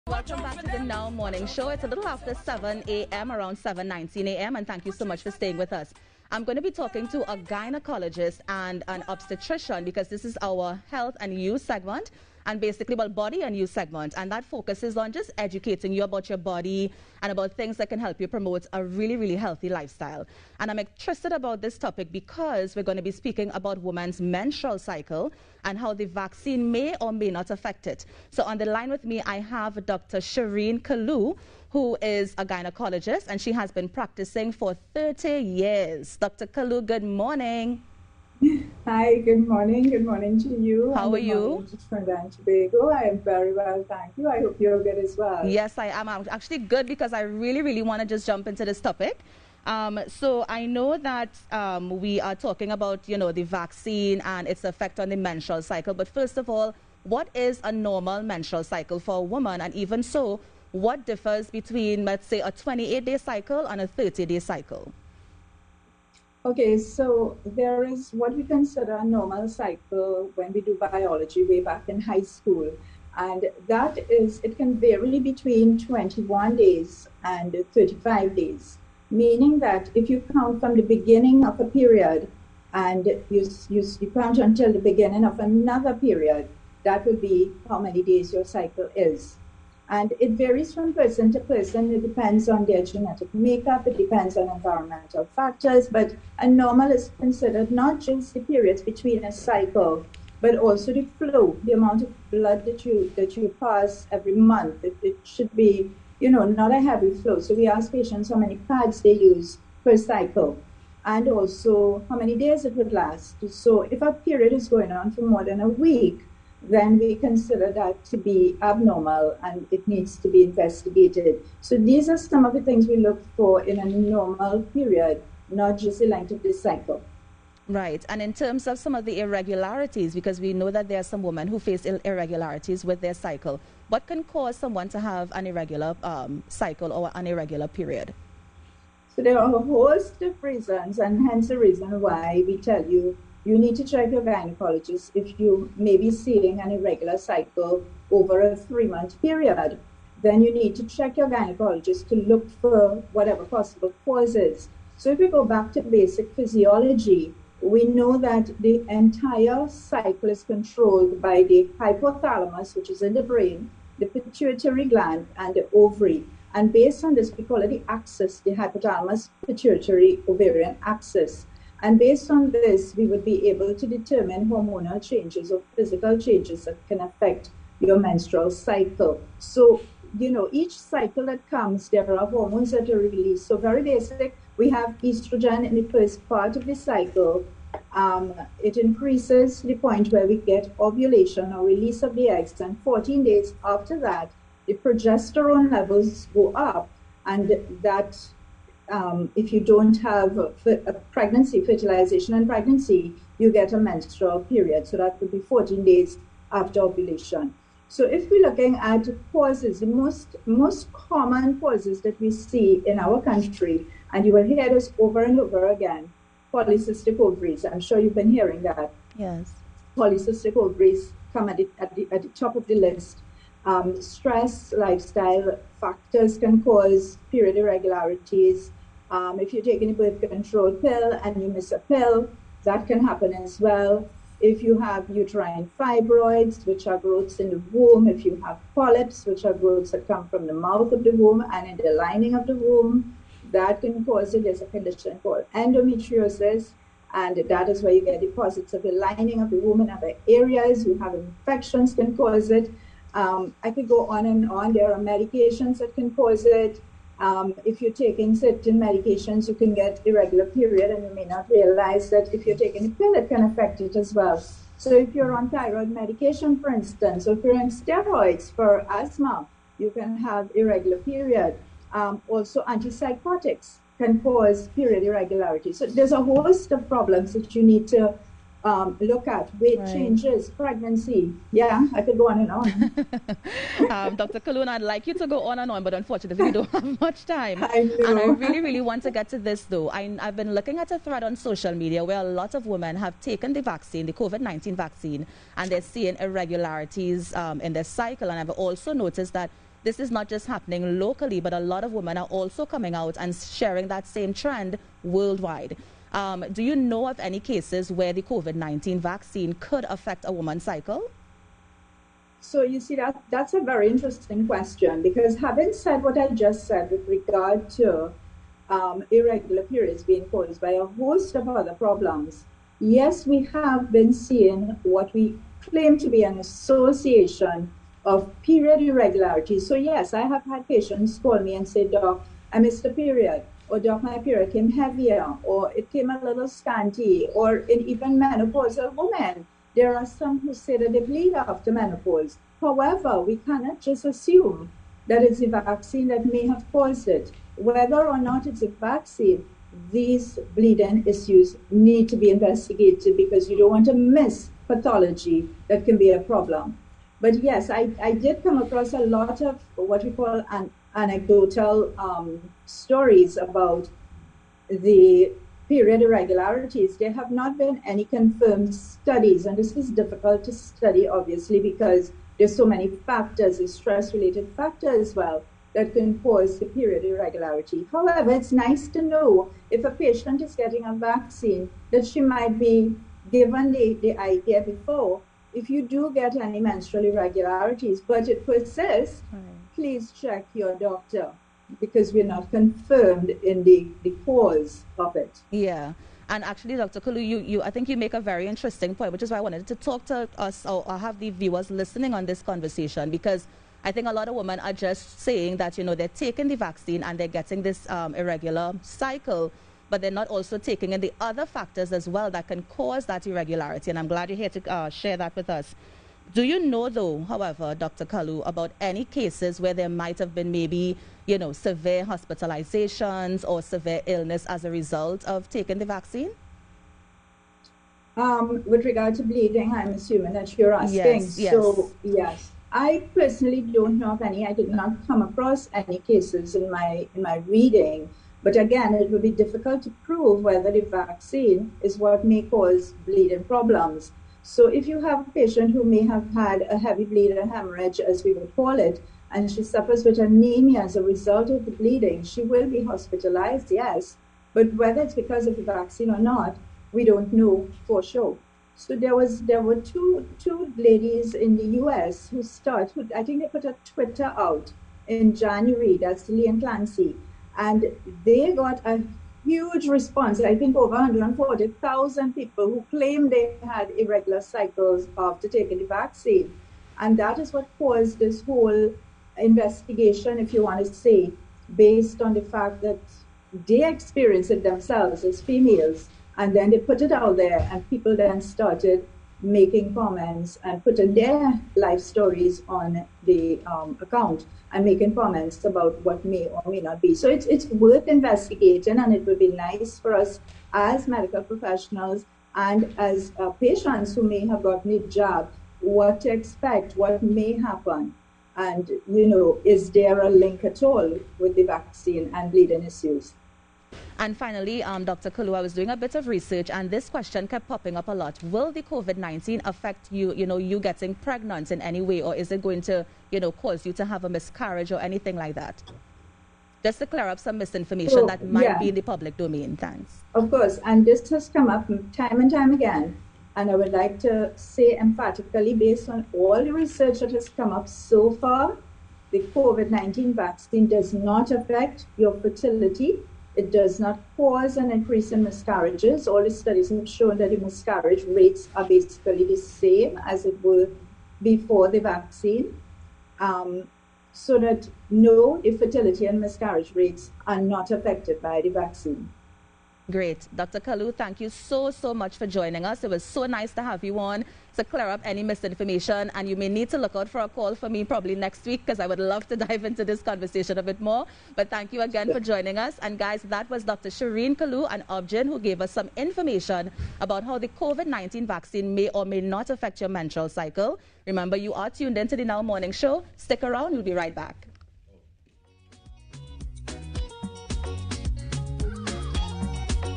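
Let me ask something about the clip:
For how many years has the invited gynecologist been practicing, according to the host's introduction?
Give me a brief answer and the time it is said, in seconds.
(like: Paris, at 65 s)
30, at 34 s.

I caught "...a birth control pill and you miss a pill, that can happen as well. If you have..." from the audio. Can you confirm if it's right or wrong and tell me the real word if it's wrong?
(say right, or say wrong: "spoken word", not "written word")
right.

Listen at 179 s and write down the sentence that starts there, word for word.
So, you know, each cycle that comes, there are hormones that are released.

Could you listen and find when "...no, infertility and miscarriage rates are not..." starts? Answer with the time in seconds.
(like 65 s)
555 s.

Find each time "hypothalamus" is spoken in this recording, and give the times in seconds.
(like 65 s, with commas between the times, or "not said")
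161 s, 168 s.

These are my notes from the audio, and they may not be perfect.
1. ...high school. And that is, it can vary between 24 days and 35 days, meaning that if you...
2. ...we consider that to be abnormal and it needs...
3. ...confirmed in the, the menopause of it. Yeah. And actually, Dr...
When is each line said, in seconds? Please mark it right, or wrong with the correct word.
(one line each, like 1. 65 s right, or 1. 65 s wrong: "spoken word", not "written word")
1. 72 s wrong: "21", not "24"
2. 116 s right
3. 392 s wrong: "cause", not "menopause".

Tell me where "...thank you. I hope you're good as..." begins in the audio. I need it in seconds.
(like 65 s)
43 s.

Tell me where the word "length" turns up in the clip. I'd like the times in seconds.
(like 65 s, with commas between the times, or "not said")
126 s.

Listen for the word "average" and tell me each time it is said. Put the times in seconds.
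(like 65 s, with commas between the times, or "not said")
not said.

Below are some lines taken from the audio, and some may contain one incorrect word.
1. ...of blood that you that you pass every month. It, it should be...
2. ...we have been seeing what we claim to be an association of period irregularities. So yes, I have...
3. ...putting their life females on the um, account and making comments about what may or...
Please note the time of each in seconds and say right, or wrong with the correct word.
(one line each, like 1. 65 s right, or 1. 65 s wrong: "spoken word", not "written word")
1. 102 s right
2. 323 s right
3. 490 s wrong: "stories", not "females".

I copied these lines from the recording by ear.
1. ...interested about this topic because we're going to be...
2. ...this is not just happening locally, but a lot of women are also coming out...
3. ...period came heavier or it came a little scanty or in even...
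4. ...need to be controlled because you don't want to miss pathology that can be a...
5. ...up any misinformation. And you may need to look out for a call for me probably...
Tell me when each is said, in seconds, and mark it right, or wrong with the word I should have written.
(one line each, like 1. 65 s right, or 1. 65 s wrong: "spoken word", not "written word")
1. 20 s right
2. 299 s right
3. 334 s right
4. 351 s wrong: "investigated", not "controlled"
5. 565 s right.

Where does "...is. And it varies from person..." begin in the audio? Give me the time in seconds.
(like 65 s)
88 s.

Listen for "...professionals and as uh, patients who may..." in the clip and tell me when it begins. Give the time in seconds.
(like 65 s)
501 s.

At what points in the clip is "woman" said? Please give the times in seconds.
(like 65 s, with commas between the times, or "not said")
59 s, 310 s.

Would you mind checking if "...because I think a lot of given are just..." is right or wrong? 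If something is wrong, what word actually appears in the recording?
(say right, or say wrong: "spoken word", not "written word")
wrong: "women", not "given".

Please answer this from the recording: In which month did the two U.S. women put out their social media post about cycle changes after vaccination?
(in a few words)
January.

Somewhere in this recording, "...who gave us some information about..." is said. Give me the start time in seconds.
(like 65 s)
575 s.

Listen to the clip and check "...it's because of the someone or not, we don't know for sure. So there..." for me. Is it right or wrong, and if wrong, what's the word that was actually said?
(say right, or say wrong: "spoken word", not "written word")
wrong: "vaccine", not "someone".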